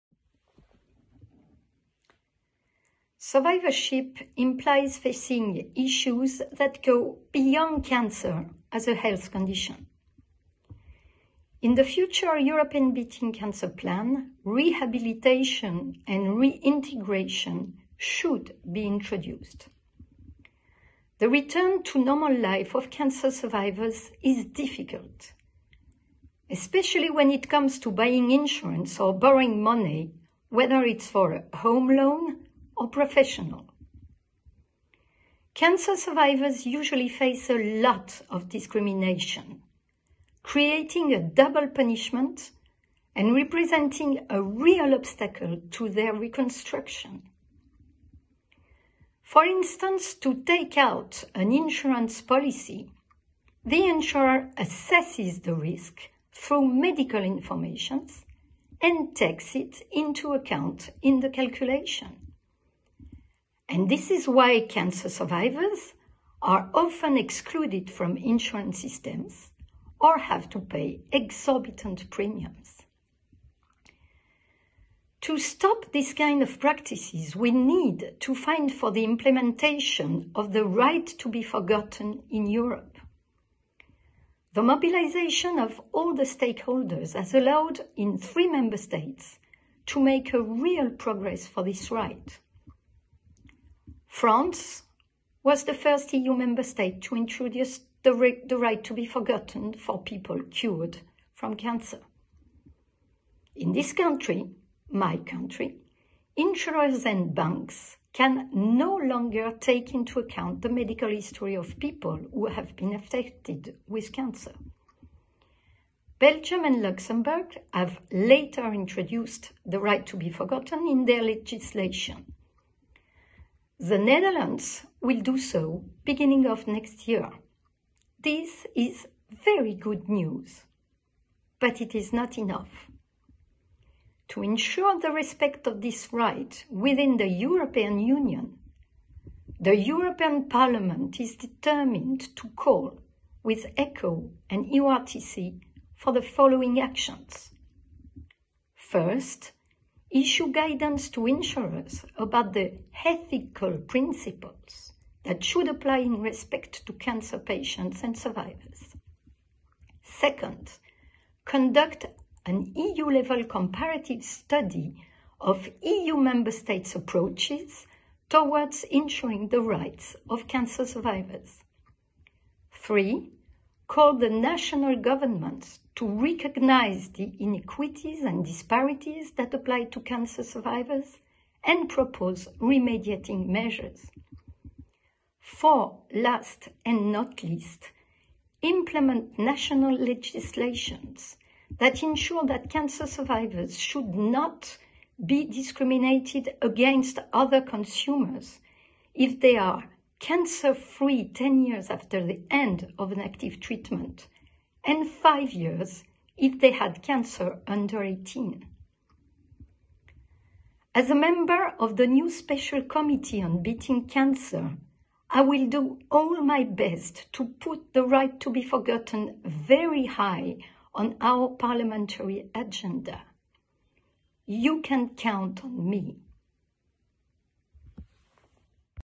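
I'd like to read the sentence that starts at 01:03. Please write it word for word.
And this is why cancer survivors are often excluded from insurance systems or have to pay exorbitant premiums.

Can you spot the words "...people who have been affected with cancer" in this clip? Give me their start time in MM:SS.
01:51.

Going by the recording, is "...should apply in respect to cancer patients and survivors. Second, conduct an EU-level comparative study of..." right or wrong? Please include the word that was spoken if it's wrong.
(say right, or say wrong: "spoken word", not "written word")
right.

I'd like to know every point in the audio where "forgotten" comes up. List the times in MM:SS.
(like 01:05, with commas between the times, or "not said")
01:21, 01:39, 02:00, 03:38.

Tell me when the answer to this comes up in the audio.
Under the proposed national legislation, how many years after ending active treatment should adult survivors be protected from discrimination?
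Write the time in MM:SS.
03:21.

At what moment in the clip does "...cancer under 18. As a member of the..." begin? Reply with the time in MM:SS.
03:27.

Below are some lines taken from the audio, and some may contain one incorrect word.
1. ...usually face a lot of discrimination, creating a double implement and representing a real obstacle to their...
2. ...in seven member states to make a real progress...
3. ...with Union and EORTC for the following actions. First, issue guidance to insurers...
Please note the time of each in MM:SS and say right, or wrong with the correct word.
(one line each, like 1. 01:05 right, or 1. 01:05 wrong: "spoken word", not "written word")
1. 00:36 wrong: "punishment", not "implement"
2. 01:27 wrong: "three", not "seven"
3. 02:23 wrong: "ECCO", not "Union".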